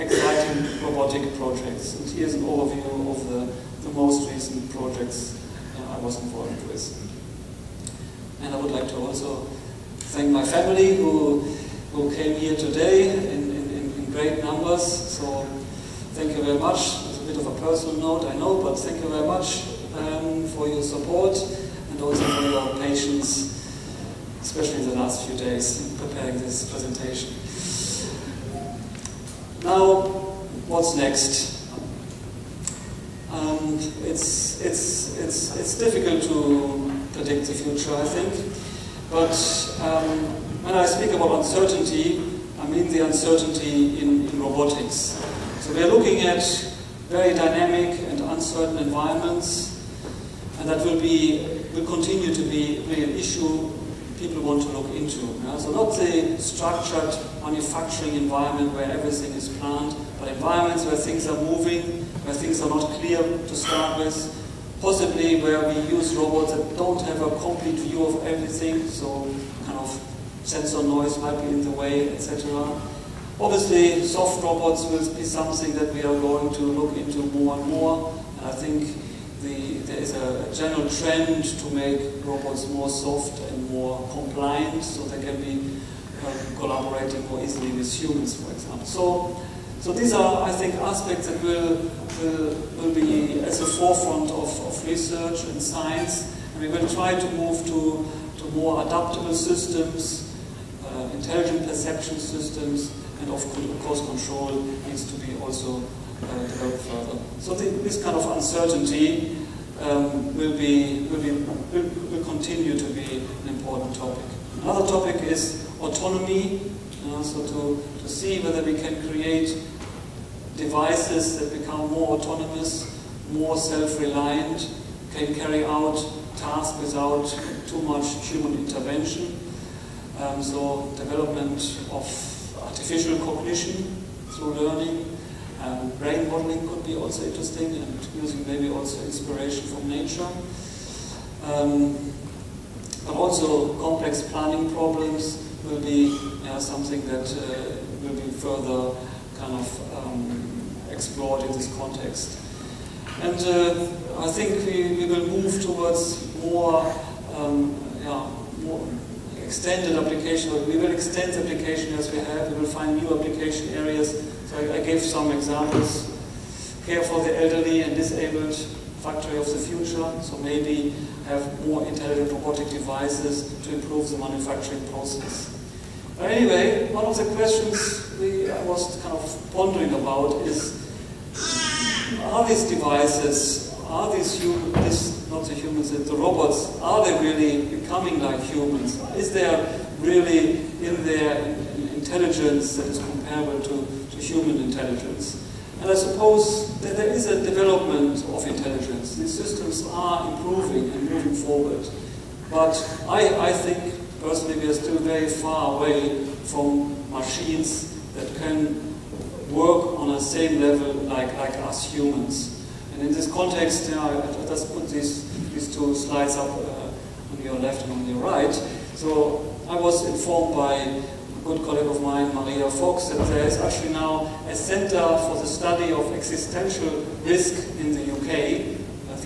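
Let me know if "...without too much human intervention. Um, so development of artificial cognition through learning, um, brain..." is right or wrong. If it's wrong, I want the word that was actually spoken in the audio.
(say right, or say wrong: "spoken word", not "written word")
right.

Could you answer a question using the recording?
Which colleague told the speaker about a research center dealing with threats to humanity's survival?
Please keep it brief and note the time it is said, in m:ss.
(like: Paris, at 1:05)
Maria Fox, at 3:42.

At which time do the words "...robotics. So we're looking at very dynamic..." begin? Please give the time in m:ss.
0:44.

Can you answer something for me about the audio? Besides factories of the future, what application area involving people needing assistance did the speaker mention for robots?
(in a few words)
Care for the elderly and disabled.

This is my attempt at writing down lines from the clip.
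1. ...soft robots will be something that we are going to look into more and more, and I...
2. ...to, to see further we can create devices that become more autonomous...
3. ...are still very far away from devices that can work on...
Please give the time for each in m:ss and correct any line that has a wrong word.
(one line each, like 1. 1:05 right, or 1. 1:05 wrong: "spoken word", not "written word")
1. 1:14 right
2. 1:57 wrong: "whether", not "further"
3. 3:24 wrong: "machines", not "devices".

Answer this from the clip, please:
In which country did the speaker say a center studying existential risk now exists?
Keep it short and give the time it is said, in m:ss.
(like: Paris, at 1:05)
UK, at 3:48.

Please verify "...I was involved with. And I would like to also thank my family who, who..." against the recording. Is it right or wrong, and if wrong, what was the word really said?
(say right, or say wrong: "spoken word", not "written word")
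right.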